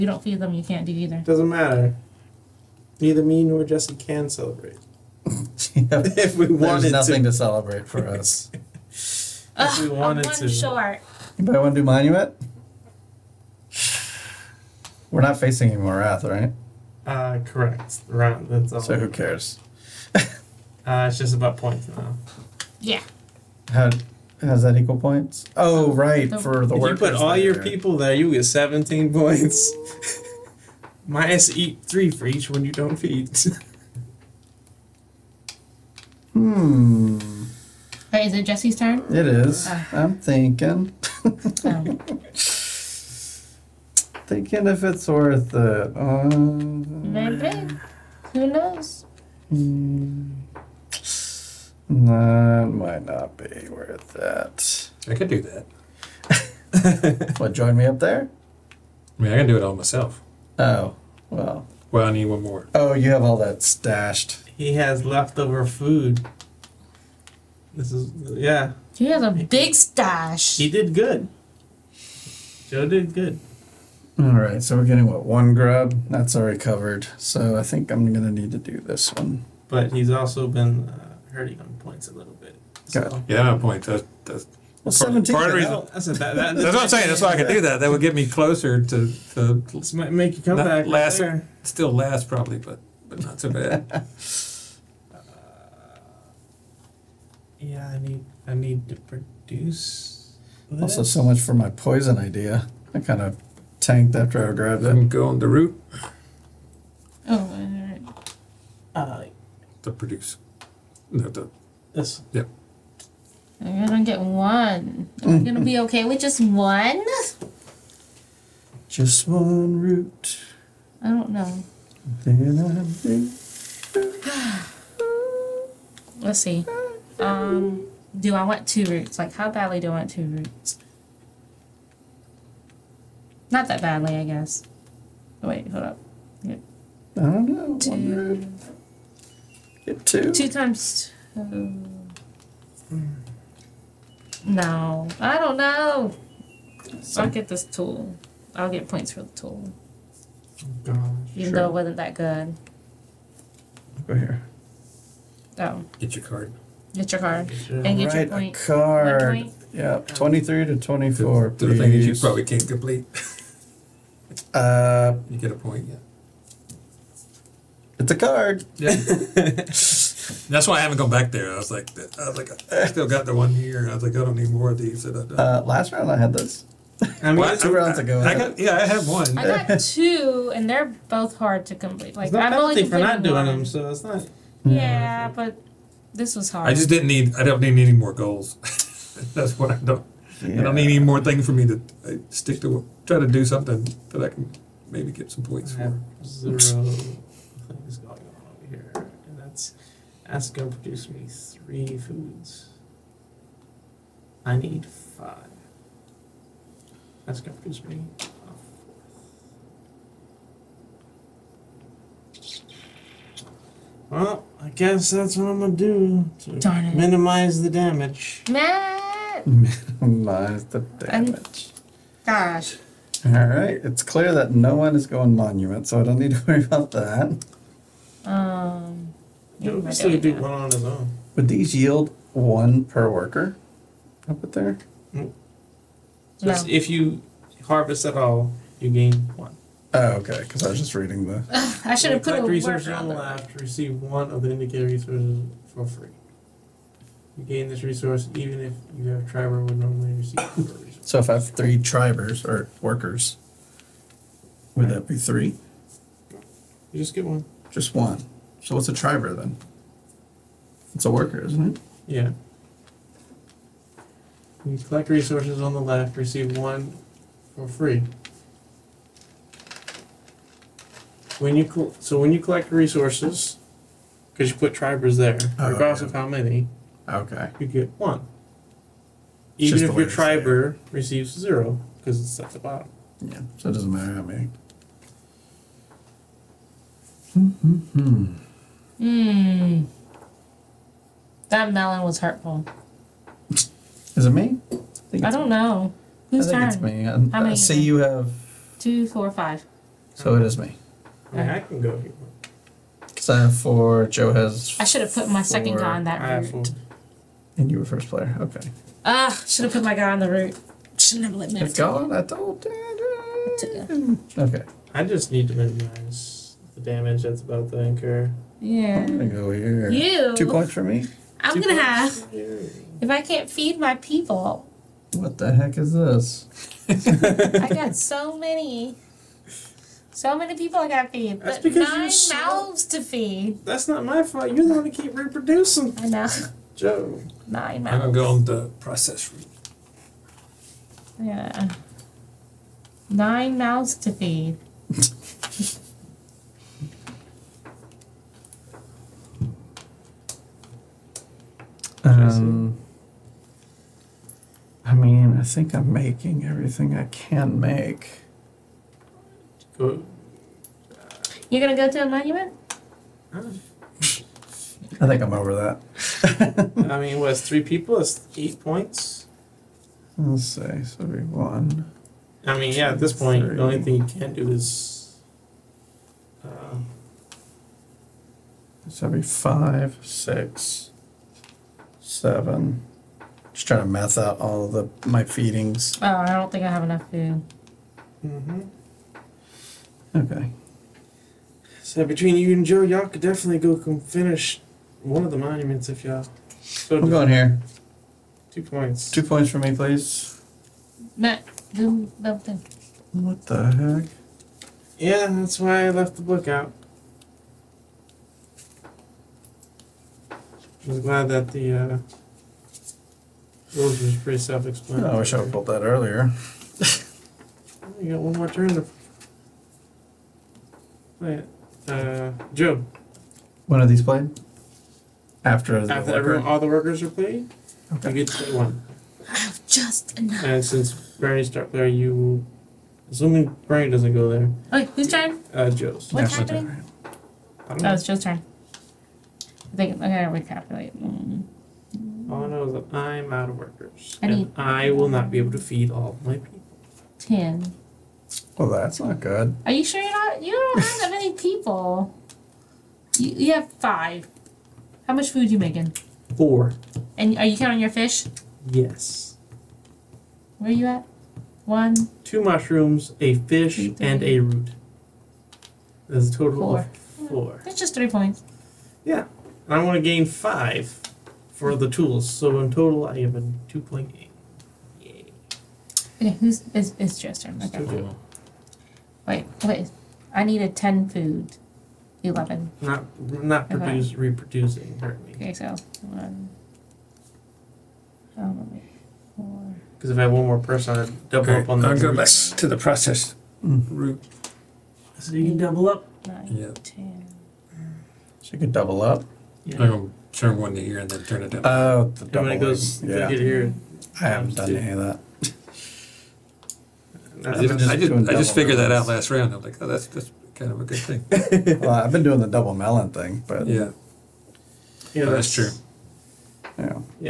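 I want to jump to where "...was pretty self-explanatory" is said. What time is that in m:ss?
6:54.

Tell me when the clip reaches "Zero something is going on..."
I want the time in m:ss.
3:16.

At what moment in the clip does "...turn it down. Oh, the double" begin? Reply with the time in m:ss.
8:21.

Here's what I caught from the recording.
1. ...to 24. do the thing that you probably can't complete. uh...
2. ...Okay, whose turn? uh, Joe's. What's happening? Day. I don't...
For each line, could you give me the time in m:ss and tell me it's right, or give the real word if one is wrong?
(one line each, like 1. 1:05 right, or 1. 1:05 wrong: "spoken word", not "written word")
1. 2:40 right
2. 7:14 right.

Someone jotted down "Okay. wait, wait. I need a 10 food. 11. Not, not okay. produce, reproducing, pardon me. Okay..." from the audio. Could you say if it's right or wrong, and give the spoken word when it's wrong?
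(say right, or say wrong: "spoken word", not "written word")
right.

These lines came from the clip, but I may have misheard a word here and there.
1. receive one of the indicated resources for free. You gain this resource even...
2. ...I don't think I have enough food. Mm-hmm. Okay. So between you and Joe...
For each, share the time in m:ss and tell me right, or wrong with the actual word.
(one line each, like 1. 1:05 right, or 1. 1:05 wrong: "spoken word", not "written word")
1. 4:03 right
2. 6:26 right.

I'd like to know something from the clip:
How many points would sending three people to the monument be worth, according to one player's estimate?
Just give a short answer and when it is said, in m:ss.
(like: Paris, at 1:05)
8, at 6:08.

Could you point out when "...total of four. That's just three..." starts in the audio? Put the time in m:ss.
7:46.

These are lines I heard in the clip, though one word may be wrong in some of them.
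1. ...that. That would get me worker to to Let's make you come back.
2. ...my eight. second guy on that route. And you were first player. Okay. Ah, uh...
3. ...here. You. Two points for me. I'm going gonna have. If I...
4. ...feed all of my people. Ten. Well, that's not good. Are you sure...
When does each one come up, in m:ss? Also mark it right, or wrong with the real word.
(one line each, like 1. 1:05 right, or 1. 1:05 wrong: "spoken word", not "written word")
1. 1:27 wrong: "closer", not "worker"
2. 5:05 wrong: "four", not "eight"
3. 5:19 right
4. 7:25 right.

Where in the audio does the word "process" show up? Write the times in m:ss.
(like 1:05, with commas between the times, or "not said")
5:38, 8:12.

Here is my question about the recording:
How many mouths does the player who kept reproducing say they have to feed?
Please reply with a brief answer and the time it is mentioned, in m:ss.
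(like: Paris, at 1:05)
9, at 5:43.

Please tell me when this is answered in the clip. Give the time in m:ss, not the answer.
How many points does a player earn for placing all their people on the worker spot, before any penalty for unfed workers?
0:28.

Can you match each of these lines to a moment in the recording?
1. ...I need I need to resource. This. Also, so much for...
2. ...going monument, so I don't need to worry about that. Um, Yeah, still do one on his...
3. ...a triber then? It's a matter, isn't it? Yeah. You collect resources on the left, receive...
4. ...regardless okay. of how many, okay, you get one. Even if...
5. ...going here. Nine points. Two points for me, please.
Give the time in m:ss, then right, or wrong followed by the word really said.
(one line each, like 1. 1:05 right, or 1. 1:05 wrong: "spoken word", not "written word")
1. 1:37 wrong: "produce", not "resource"
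2. 3:45 right
3. 4:18 wrong: "worker", not "matter"
4. 4:35 right
5. 6:37 wrong: "Two", not "Nine".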